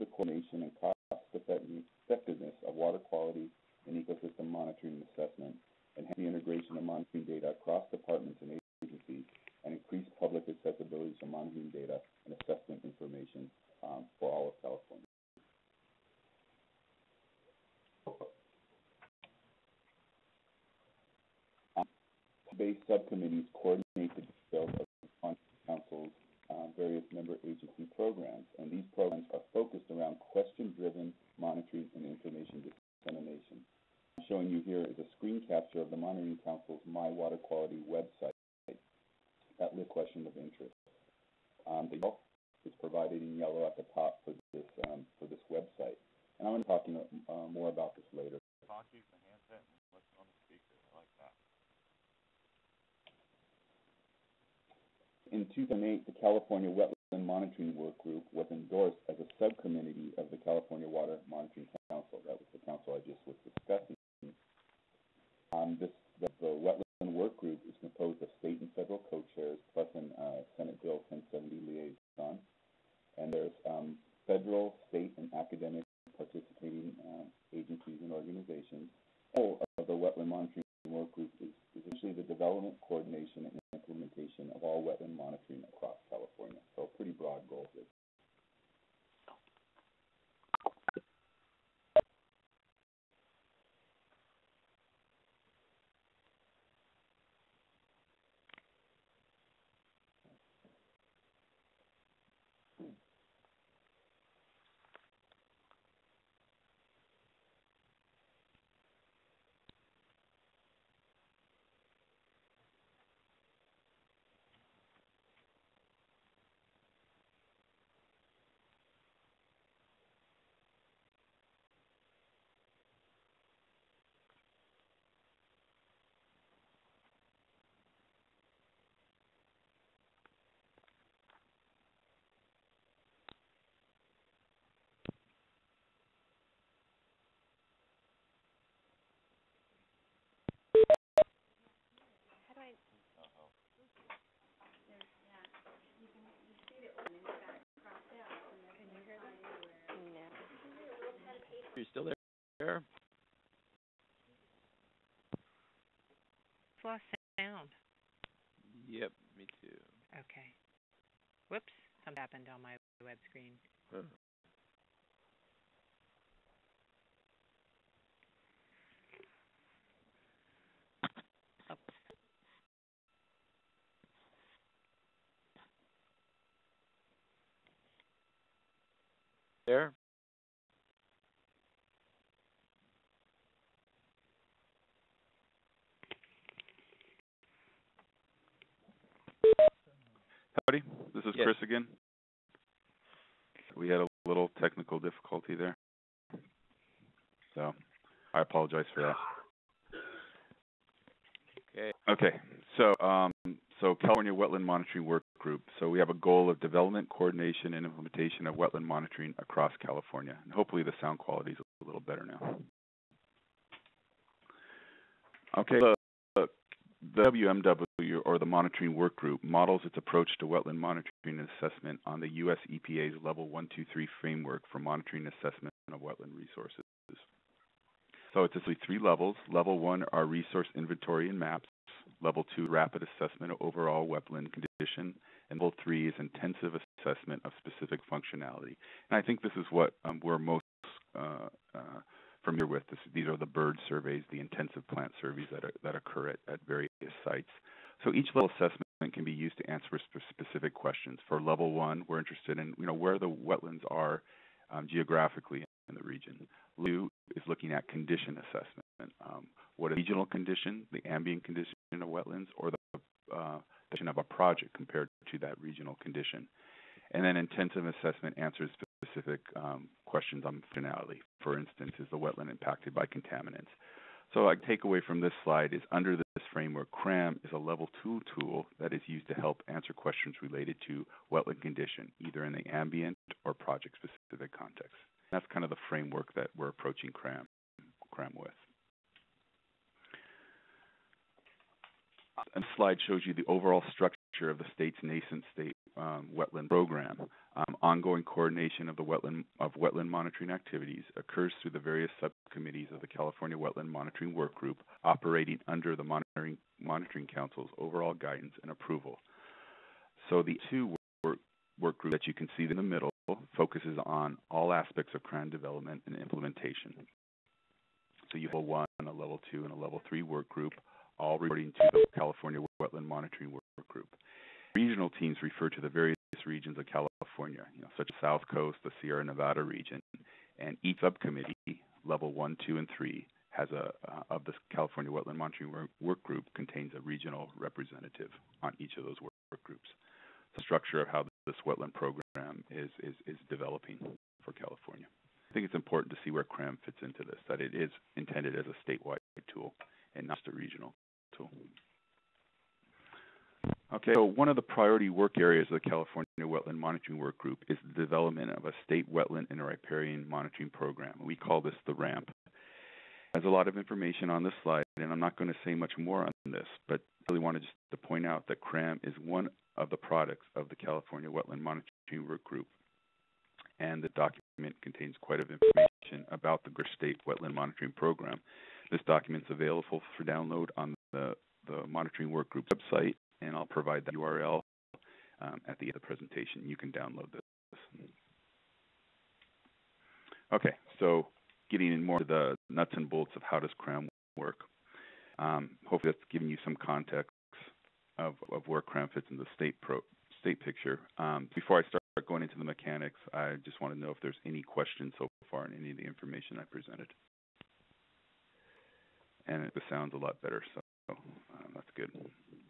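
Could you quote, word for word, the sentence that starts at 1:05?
Um, this, the, the, Wetland Work Group is composed of state and federal co-chairs, plus an uh, Senate Bill 1070 liaison.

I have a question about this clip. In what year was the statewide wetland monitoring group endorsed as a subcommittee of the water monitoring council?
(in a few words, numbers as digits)
2008.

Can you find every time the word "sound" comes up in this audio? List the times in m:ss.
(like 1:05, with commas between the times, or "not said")
2:37, 3:31, 6:49.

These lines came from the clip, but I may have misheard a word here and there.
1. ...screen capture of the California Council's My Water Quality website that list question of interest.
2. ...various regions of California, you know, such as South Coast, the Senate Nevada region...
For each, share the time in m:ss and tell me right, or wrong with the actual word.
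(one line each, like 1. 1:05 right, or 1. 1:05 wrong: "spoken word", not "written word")
1. 0:35 wrong: "Monitoring", not "California"
2. 5:25 wrong: "Sierra", not "Senate".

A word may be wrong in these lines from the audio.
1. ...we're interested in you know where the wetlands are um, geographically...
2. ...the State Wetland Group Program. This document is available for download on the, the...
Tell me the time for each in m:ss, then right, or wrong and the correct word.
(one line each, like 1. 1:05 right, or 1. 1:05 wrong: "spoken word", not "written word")
1. 4:12 right
2. 6:16 wrong: "Monitoring", not "Group".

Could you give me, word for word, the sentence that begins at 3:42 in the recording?
EPA's Level 123 framework for monitoring assessment of wetland resources.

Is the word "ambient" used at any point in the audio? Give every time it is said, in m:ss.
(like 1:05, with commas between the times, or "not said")
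4:21, 4:42.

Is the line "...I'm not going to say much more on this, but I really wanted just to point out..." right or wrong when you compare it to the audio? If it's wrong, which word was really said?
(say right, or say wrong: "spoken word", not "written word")
right.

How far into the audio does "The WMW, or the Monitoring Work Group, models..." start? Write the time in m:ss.
3:37.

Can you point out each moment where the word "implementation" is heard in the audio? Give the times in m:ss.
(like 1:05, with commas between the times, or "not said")
1:23, 3:27, 5:16.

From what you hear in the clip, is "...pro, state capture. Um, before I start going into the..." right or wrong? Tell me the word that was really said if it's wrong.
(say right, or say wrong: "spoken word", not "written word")
wrong: "picture", not "capture".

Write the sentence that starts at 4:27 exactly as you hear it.
And then intensive assessment answers specific um, questions on finality.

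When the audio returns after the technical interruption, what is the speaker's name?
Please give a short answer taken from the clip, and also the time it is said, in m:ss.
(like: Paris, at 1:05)
Chris, at 3:11.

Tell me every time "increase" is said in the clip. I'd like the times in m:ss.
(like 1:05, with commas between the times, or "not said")
0:09.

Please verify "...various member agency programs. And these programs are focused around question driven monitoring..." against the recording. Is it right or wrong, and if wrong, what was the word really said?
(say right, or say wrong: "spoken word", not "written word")
right.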